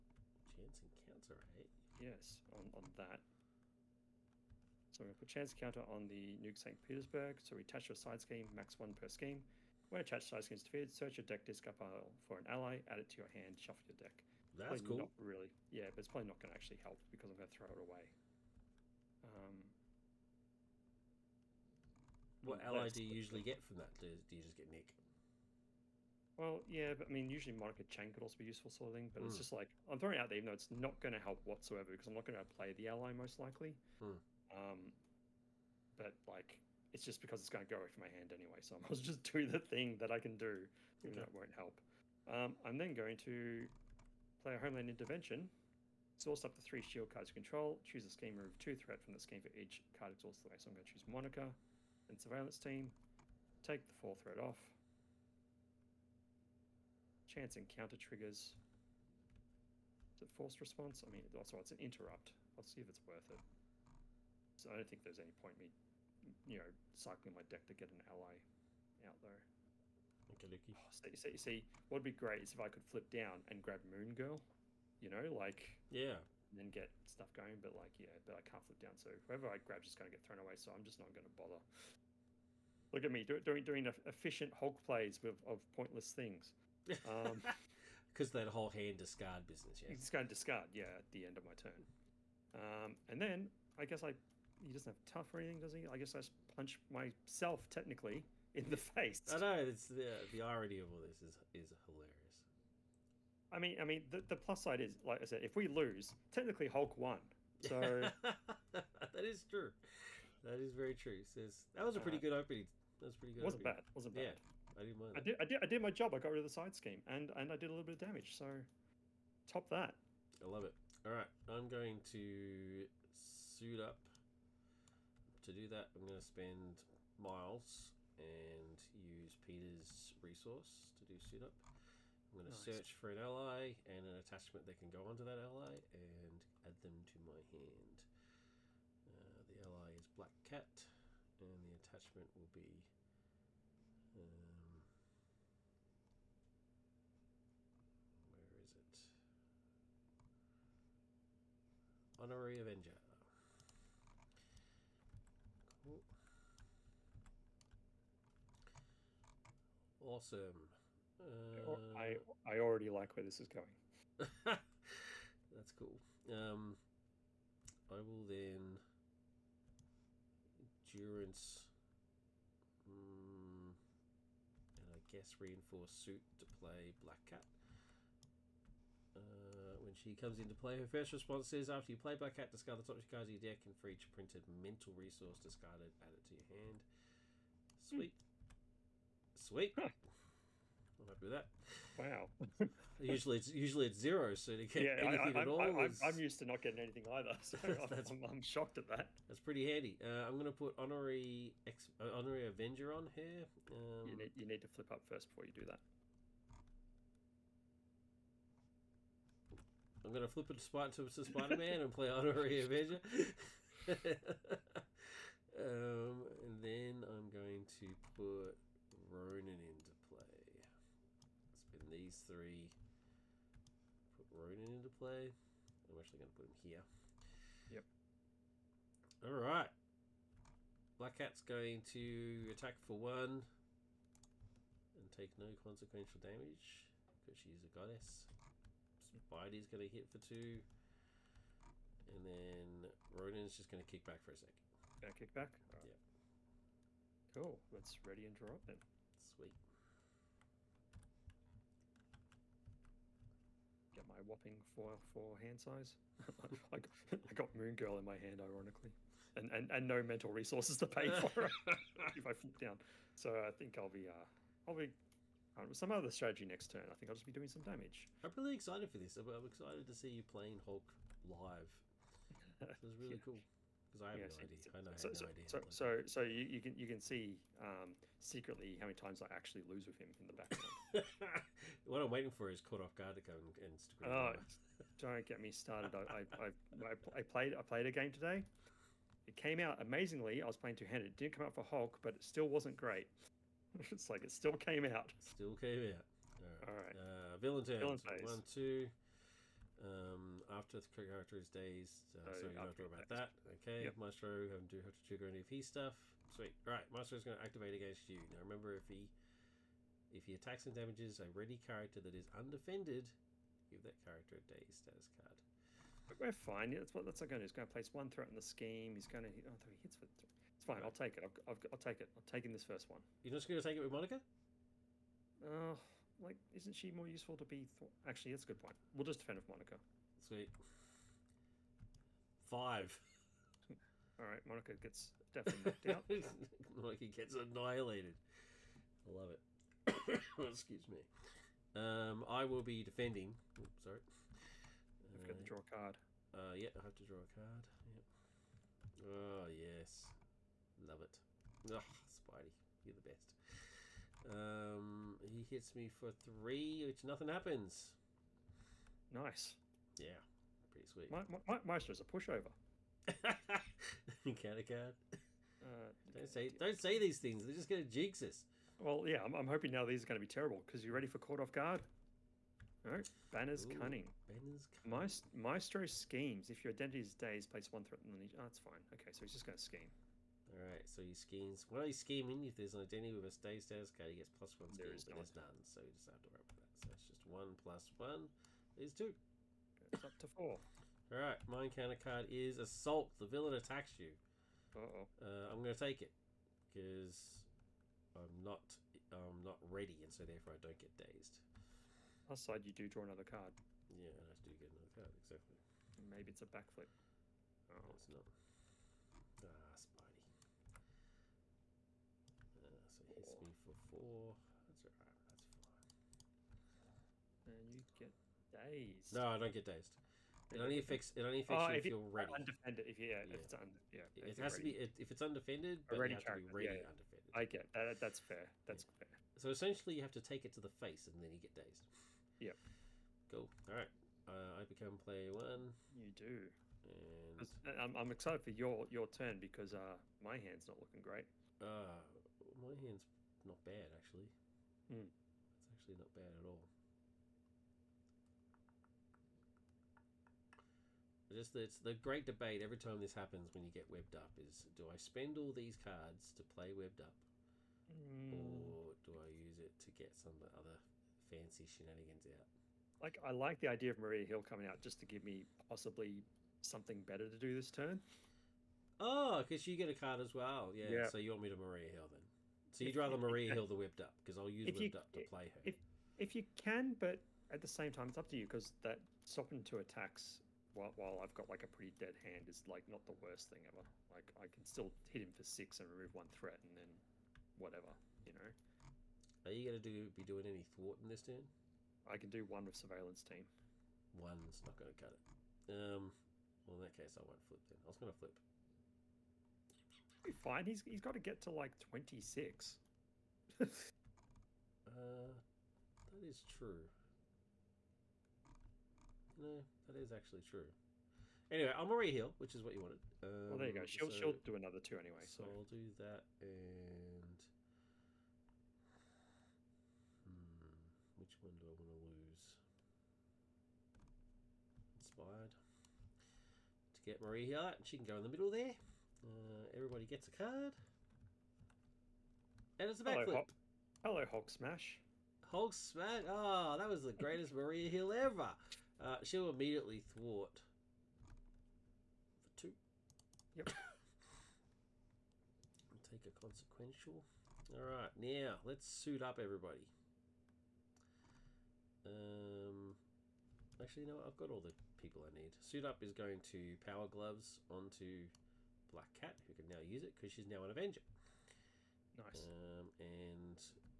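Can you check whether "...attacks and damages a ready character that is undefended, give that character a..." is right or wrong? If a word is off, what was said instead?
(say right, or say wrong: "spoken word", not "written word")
right.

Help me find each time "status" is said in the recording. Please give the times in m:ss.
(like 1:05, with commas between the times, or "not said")
5:14, 6:23.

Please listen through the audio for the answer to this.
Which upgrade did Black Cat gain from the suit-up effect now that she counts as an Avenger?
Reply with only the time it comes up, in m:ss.
9:16.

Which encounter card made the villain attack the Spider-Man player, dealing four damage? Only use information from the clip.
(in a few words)
Assault.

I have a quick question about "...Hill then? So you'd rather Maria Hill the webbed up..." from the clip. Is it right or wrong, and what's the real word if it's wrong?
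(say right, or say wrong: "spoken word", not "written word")
right.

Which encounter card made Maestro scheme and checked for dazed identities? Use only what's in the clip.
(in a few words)
Banner's Cunning.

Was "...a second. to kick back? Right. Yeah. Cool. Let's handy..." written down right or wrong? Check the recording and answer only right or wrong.
wrong.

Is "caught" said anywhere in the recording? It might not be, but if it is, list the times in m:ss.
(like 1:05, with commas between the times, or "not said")
4:42, 6:11.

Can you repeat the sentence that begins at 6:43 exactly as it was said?
Yeah, and I do get another card, exactly.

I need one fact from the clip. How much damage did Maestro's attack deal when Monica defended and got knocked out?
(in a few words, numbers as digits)
5.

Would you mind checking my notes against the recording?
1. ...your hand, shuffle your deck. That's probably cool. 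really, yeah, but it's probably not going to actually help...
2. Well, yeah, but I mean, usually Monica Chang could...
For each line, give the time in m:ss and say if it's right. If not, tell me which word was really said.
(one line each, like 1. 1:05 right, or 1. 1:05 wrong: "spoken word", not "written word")
1. 0:13 right
2. 0:26 right.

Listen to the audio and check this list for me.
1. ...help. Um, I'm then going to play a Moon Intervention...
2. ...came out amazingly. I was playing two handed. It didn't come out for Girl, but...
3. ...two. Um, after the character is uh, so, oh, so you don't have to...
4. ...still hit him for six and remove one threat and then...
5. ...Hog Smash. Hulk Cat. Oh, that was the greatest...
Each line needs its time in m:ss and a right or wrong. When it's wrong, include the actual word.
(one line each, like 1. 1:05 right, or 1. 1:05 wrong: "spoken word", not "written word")
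1. 0:41 wrong: "Homeland", not "Moon"
2. 4:49 wrong: "Hulk", not "Girl"
3. 4:58 right
4. 8:04 right
5. 8:54 wrong: "Smash", not "Cat".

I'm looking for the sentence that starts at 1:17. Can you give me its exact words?
But like, yeah, but I can't flip down, so whoever I grab is just gonna get thrown away.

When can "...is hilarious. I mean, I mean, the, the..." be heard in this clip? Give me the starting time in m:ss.
1:41.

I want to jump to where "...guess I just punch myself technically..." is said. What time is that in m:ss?
1:35.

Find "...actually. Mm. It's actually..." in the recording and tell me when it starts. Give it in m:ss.
7:23.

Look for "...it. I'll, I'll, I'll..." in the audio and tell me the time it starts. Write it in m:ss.
5:21.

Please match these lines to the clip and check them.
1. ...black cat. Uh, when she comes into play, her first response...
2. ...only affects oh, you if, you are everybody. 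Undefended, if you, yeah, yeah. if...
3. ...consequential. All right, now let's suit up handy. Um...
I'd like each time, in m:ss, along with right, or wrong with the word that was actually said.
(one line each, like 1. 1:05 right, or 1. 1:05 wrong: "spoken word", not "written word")
1. 2:56 right
2. 7:01 wrong: "ready", not "everybody"
3. 9:06 wrong: "everybody", not "handy".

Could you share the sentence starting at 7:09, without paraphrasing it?
So essentially, you have to take it to the face, and then you get dazed.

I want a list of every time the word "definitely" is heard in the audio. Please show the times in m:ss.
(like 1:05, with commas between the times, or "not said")
5:35.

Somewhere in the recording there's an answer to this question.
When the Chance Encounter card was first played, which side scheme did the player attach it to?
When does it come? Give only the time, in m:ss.
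0:06.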